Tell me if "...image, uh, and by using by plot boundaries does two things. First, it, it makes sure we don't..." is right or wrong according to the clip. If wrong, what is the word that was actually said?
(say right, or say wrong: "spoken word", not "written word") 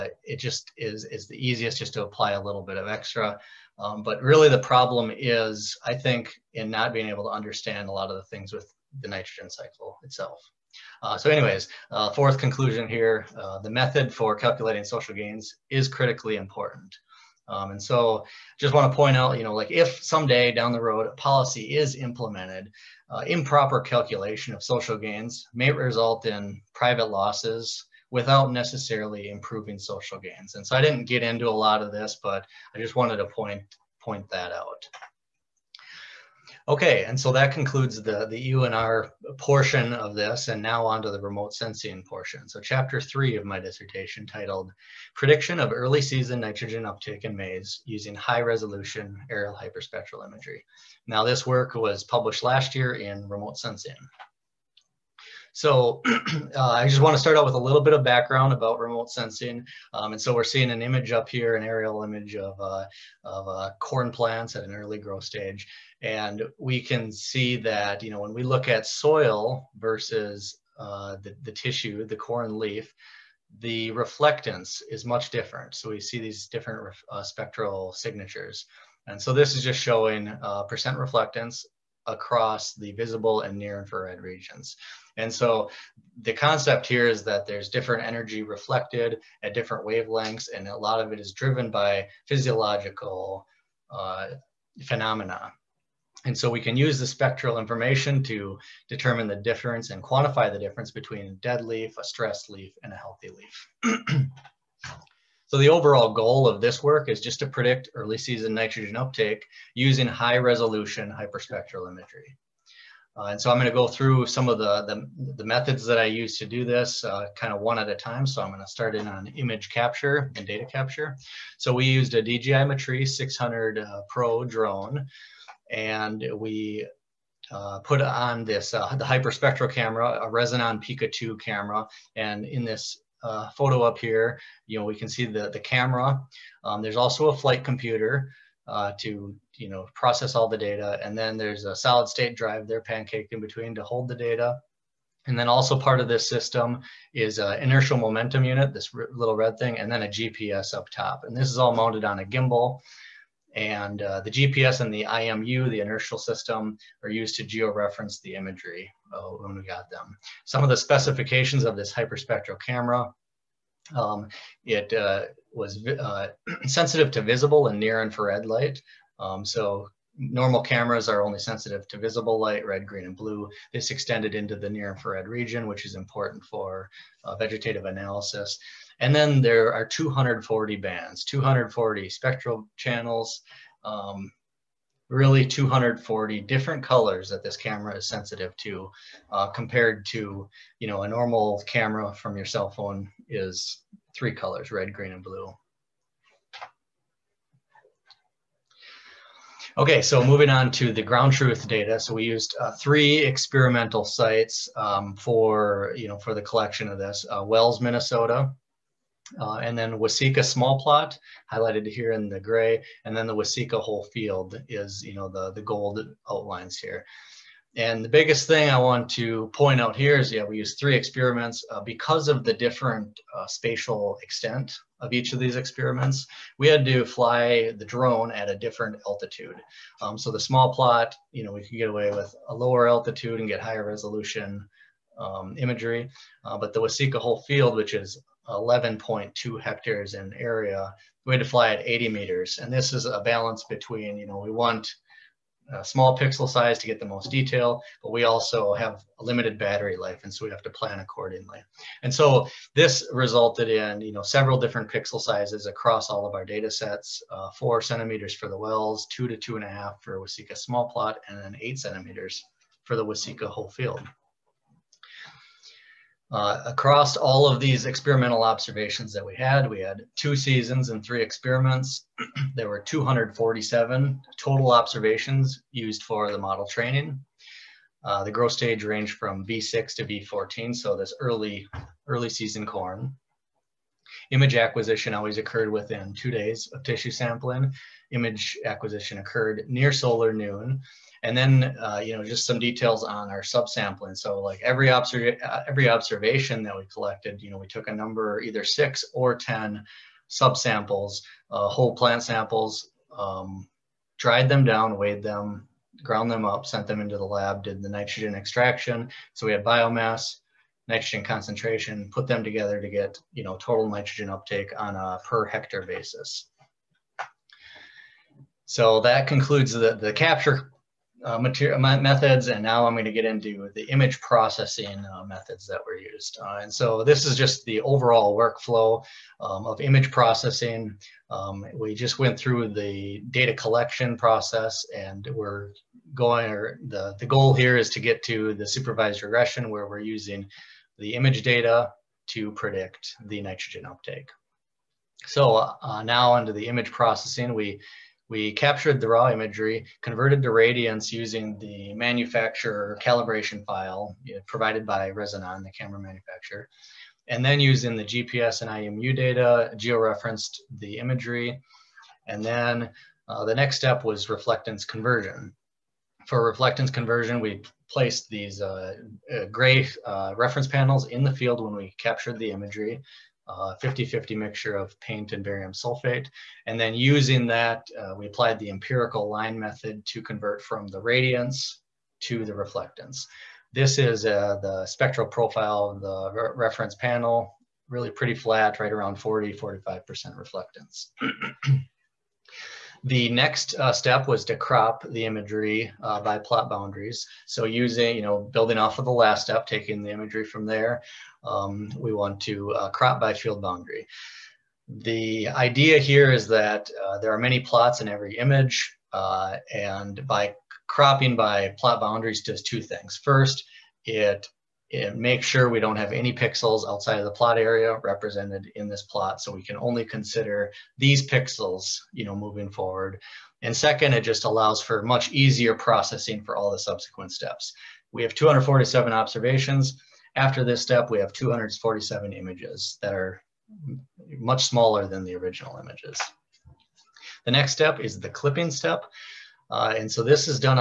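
wrong: "cropping", not "using".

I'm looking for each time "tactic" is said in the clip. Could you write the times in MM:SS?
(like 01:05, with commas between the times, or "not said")
not said.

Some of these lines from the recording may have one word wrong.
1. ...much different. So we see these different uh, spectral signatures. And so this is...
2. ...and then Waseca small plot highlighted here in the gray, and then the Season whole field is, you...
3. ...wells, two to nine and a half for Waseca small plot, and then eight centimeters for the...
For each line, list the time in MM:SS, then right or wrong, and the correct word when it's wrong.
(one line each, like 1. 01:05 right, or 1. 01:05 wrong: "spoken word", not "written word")
1. 01:15 right
2. 03:29 wrong: "Waseca", not "Season"
3. 04:18 wrong: "two", not "nine".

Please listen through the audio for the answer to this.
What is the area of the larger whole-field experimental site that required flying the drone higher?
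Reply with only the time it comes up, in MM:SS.
03:58.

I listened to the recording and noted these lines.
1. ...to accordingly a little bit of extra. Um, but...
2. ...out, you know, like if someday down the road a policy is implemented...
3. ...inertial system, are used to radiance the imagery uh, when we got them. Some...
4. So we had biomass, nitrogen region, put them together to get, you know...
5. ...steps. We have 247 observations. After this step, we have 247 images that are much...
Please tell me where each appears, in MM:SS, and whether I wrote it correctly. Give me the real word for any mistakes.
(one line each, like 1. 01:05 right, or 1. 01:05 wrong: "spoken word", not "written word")
1. 00:01 wrong: "apply", not "accordingly"
2. 00:19 right
3. 02:35 wrong: "georeference", not "radiance"
4. 05:09 wrong: "concentration", not "region"
5. 07:07 right.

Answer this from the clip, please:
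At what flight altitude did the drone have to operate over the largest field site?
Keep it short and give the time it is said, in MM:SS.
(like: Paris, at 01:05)
80 meters, at 04:01.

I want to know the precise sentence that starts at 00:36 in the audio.
Okay, and so that concludes the, the UNR portion of this, and now on to the remote sensing portion.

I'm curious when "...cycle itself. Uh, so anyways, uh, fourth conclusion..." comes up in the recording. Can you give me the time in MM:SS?
00:09.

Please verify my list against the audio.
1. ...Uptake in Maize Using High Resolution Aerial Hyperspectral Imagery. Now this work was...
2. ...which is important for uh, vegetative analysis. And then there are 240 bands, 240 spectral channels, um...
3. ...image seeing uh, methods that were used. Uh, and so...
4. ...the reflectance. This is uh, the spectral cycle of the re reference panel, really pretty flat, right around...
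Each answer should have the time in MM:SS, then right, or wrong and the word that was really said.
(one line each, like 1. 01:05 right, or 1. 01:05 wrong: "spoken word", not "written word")
1. 00:46 right
2. 02:55 right
3. 05:23 wrong: "processing", not "seeing"
4. 06:22 wrong: "profile", not "cycle".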